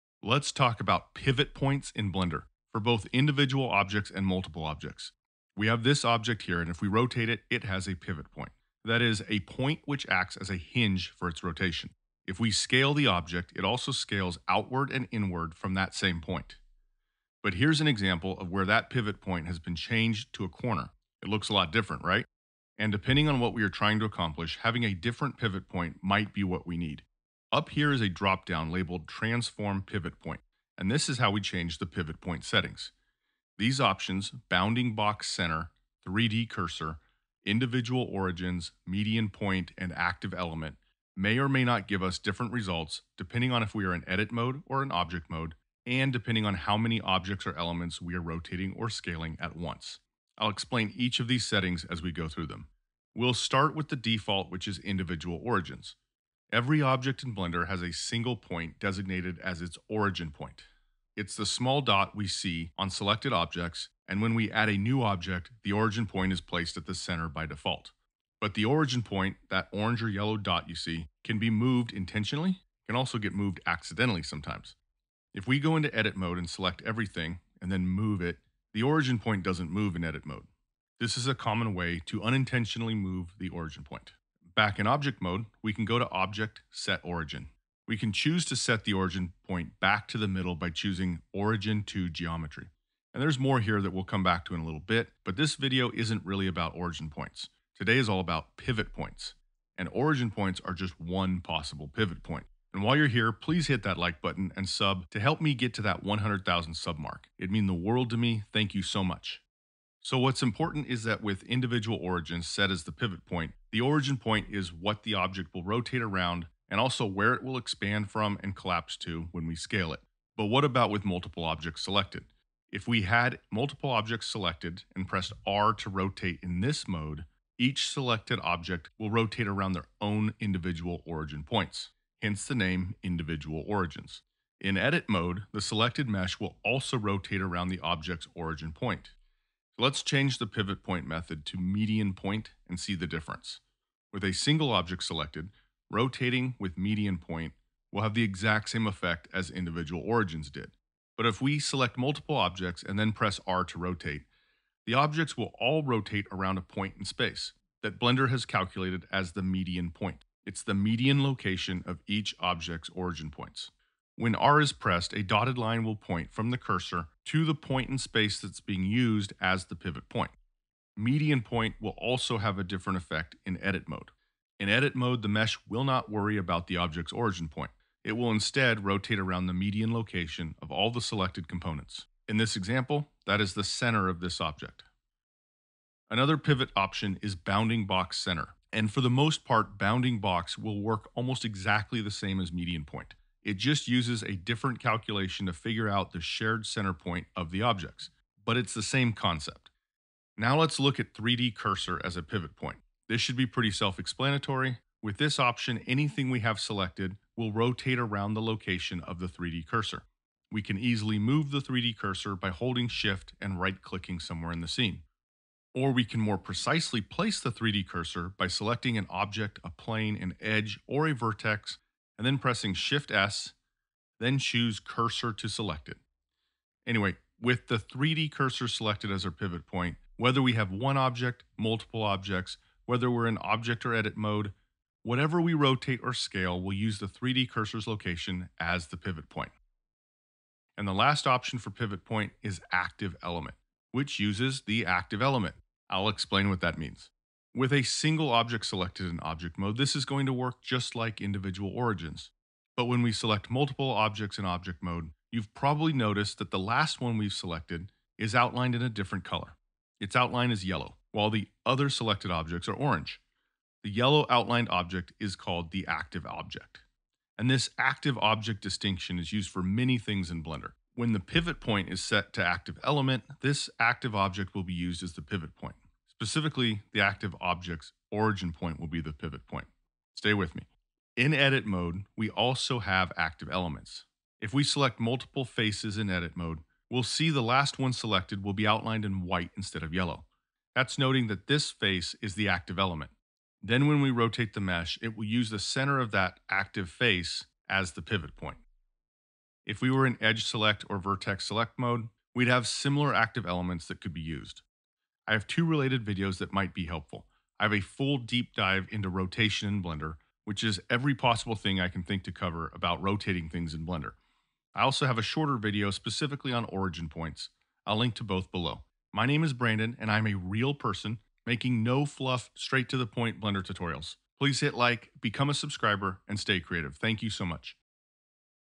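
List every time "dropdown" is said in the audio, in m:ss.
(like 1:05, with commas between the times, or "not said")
0:28.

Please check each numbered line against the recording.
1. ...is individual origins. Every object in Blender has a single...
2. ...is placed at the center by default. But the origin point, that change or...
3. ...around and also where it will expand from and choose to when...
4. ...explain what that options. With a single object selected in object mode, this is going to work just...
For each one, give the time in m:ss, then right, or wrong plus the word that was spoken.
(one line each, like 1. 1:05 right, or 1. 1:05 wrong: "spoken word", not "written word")
1. 0:54 right
2. 1:06 wrong: "orange", not "change"
3. 1:56 wrong: "collapse", not "choose"
4. 4:06 wrong: "means", not "options".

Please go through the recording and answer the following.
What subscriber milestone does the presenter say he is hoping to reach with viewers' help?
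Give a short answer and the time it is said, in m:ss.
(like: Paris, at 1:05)
100,000, at 1:46.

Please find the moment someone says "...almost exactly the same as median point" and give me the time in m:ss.
3:11.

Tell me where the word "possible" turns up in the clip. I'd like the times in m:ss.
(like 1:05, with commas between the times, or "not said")
1:41, 5:11.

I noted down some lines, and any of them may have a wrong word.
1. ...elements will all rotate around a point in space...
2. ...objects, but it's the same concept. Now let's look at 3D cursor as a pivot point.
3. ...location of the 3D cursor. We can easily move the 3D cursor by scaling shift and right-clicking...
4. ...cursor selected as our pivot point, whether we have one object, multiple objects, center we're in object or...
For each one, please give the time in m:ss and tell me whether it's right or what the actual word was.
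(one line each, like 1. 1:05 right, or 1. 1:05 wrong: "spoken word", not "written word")
1. 2:34 wrong: "objects", not "elements"
2. 3:17 right
3. 3:28 wrong: "holding", not "scaling"
4. 3:48 wrong: "whether", not "center".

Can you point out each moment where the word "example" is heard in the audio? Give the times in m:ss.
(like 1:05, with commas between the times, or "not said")
0:17, 3:02.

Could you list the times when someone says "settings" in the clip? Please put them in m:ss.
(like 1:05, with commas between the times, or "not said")
0:32, 0:51.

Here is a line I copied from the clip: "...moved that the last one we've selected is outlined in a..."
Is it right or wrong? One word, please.
wrong.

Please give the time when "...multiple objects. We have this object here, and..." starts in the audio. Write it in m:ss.
0:04.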